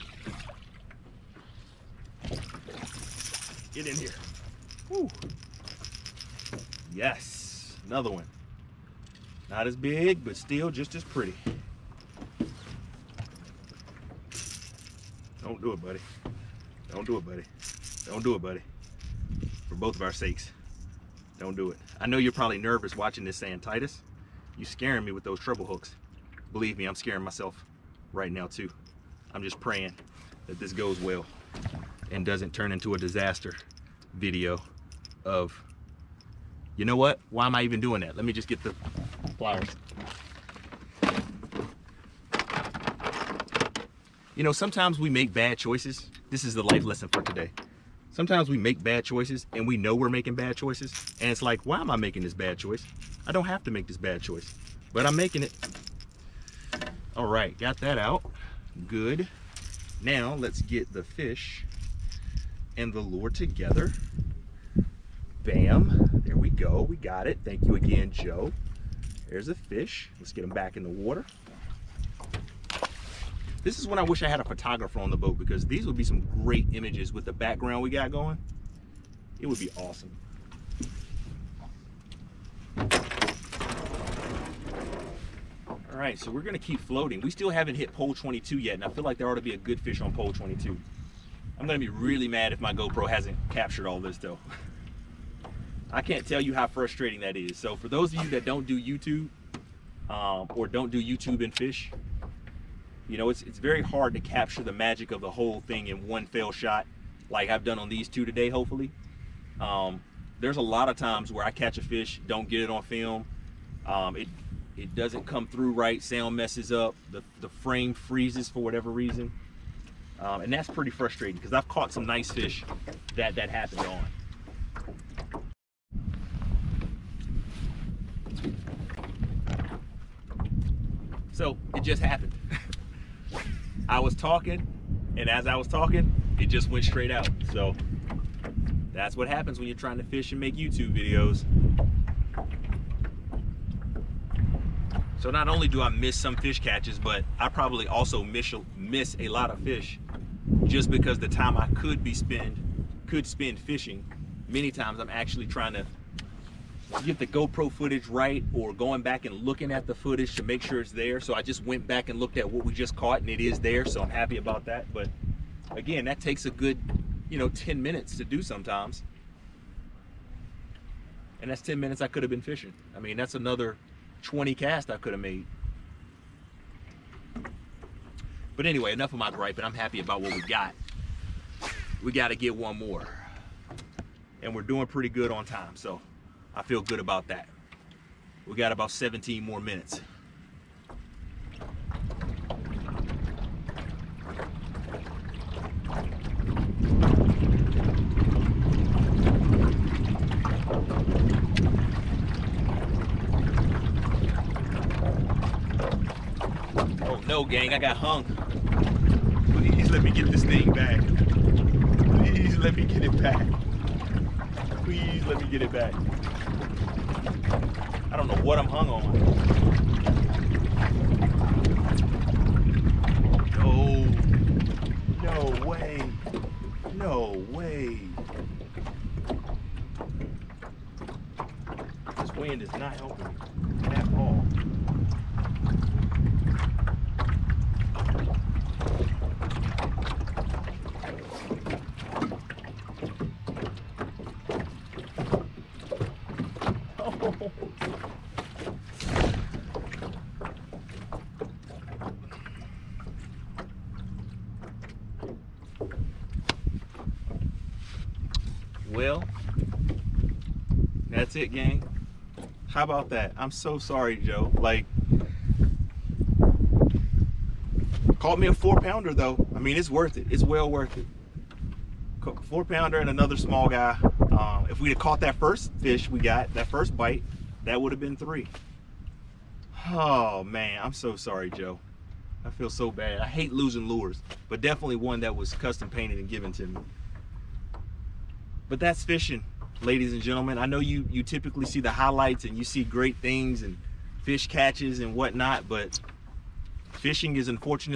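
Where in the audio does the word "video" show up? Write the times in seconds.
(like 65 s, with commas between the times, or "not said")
34 s, 140 s.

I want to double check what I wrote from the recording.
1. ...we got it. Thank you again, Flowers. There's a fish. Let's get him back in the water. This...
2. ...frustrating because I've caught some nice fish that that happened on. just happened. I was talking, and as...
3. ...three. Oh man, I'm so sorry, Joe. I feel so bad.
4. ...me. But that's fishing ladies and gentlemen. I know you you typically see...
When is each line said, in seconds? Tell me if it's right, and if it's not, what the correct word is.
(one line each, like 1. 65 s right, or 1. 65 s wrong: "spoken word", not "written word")
1. 66 s wrong: "Joe", not "Flowers"
2. 120 s right
3. 278 s right
4. 286 s right.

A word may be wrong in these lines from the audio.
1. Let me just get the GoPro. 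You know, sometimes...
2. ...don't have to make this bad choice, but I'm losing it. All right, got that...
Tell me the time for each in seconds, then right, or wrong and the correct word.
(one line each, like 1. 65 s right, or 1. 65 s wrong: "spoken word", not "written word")
1. 38 s wrong: "Flowers", not "GoPro"
2. 53 s wrong: "making", not "losing".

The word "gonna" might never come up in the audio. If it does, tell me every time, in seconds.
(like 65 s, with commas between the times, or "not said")
86 s, 91 s.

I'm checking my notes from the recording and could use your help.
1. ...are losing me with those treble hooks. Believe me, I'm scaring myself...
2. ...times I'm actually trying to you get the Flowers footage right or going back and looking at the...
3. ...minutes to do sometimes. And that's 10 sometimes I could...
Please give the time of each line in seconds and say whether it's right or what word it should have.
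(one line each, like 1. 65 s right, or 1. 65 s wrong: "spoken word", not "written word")
1. 24 s wrong: "scaring", not "losing"
2. 154 s wrong: "GoPro", not "Flowers"
3. 167 s wrong: "minutes", not "sometimes".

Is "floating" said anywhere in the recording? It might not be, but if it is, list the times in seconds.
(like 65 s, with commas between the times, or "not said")
86 s.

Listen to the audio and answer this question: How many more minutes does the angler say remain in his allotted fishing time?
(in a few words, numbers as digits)
17.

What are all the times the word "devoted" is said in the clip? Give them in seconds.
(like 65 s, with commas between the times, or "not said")
not said.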